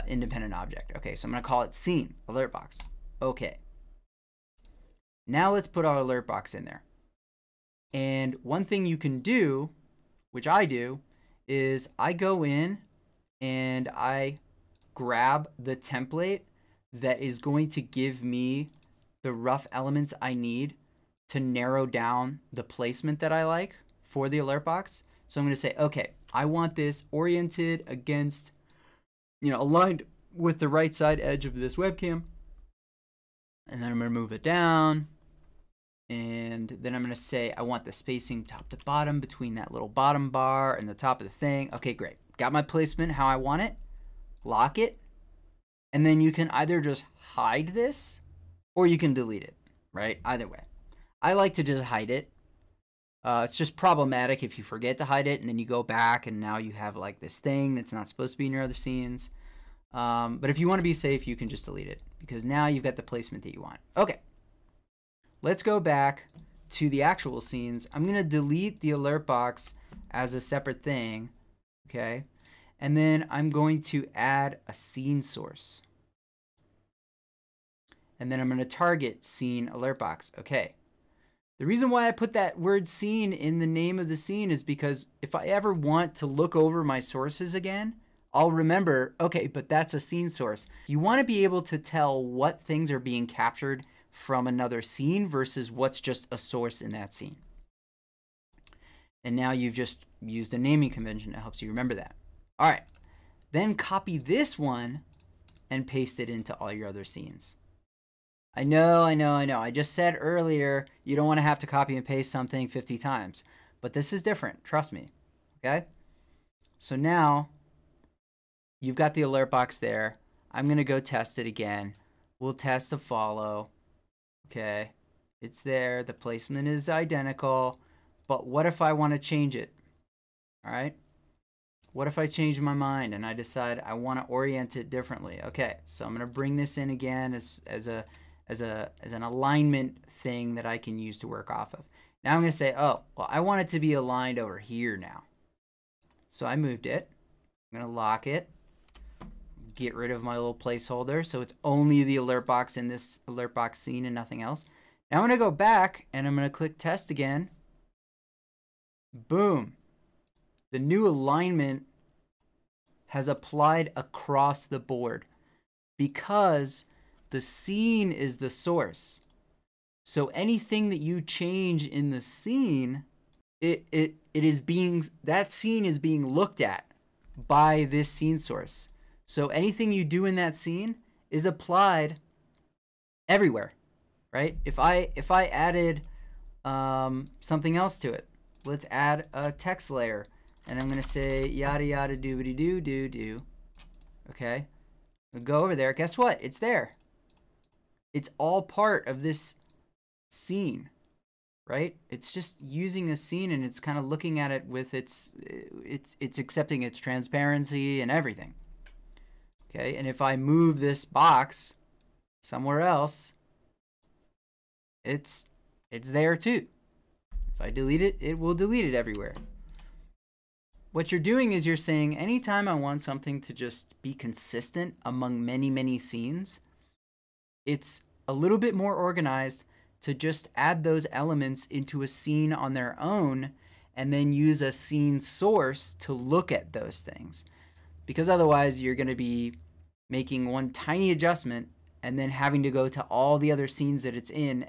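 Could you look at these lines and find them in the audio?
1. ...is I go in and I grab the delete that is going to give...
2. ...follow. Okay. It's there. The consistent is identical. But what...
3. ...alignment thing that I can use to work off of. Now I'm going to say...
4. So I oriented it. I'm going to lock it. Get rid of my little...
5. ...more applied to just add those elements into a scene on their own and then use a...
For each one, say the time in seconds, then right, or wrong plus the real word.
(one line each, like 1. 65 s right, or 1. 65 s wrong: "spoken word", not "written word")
1. 11 s wrong: "template", not "delete"
2. 122 s wrong: "placement", not "consistent"
3. 139 s right
4. 146 s wrong: "moved", not "oriented"
5. 228 s wrong: "organized", not "applied".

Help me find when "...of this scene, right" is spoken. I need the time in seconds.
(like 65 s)
199 s.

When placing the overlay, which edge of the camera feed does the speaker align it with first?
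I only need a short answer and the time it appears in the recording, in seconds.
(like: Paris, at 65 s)
right side edge, at 30 s.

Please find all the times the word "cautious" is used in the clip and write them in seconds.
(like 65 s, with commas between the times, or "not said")
not said.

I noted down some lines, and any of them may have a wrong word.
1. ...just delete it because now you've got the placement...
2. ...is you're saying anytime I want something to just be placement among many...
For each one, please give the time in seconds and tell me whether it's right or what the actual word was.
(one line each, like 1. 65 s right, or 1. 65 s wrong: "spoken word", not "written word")
1. 61 s right
2. 221 s wrong: "consistent", not "placement".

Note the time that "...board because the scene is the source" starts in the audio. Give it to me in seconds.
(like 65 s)
164 s.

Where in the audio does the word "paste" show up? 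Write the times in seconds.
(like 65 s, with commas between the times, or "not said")
105 s, 112 s.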